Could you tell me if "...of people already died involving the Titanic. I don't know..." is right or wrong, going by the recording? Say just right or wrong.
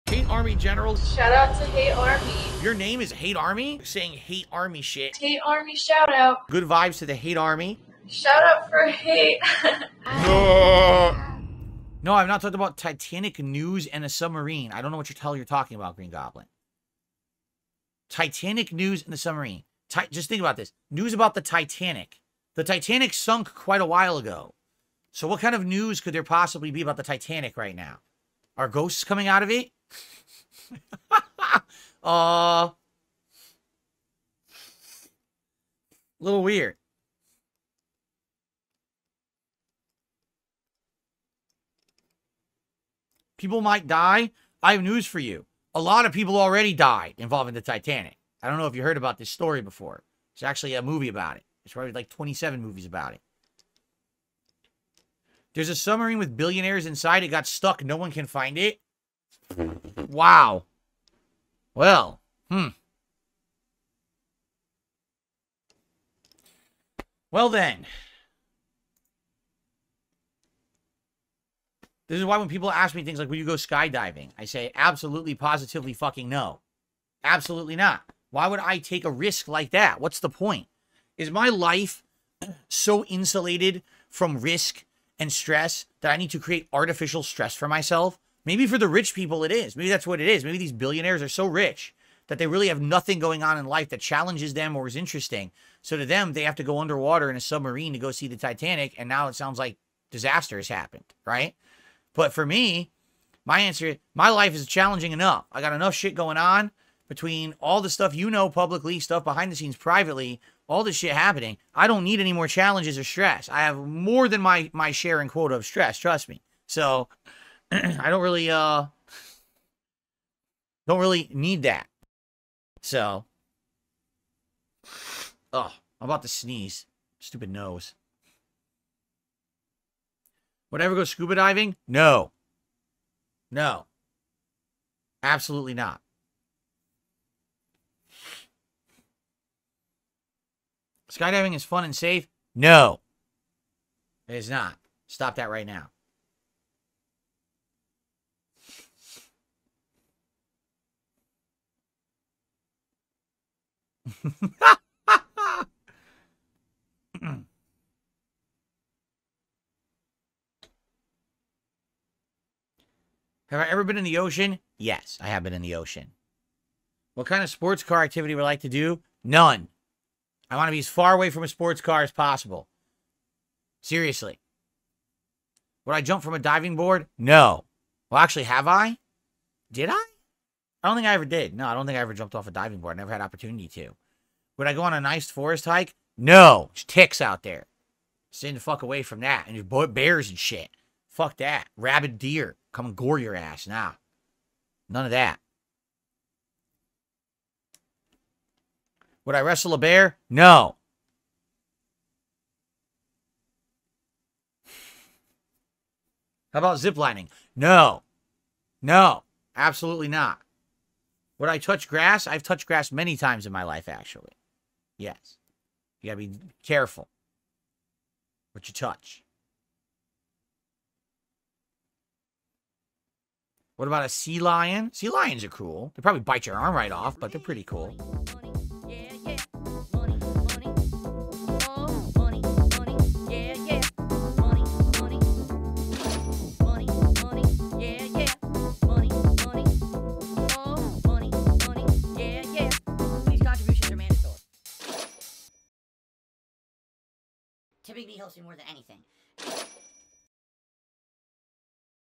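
right.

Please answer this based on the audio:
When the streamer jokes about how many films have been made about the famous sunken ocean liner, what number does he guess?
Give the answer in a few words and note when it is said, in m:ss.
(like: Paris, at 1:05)
27, at 0:52.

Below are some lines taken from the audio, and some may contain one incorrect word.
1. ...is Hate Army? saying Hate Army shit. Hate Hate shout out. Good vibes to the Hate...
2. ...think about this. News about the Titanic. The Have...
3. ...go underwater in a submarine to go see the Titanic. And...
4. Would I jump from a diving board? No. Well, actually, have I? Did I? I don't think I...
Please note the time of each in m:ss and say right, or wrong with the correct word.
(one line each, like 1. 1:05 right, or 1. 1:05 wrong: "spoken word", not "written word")
1. 0:03 wrong: "Army", not "Hate"
2. 0:20 wrong: "Titanic", not "Have"
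3. 1:36 right
4. 2:55 right.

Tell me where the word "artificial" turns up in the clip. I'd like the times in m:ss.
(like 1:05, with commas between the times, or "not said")
1:26.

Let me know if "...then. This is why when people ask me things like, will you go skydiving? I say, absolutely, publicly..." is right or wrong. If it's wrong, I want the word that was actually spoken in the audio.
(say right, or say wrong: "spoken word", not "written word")
wrong: "positively", not "publicly".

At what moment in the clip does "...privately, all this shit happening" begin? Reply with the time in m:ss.
1:49.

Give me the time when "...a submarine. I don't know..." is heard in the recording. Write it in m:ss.
0:14.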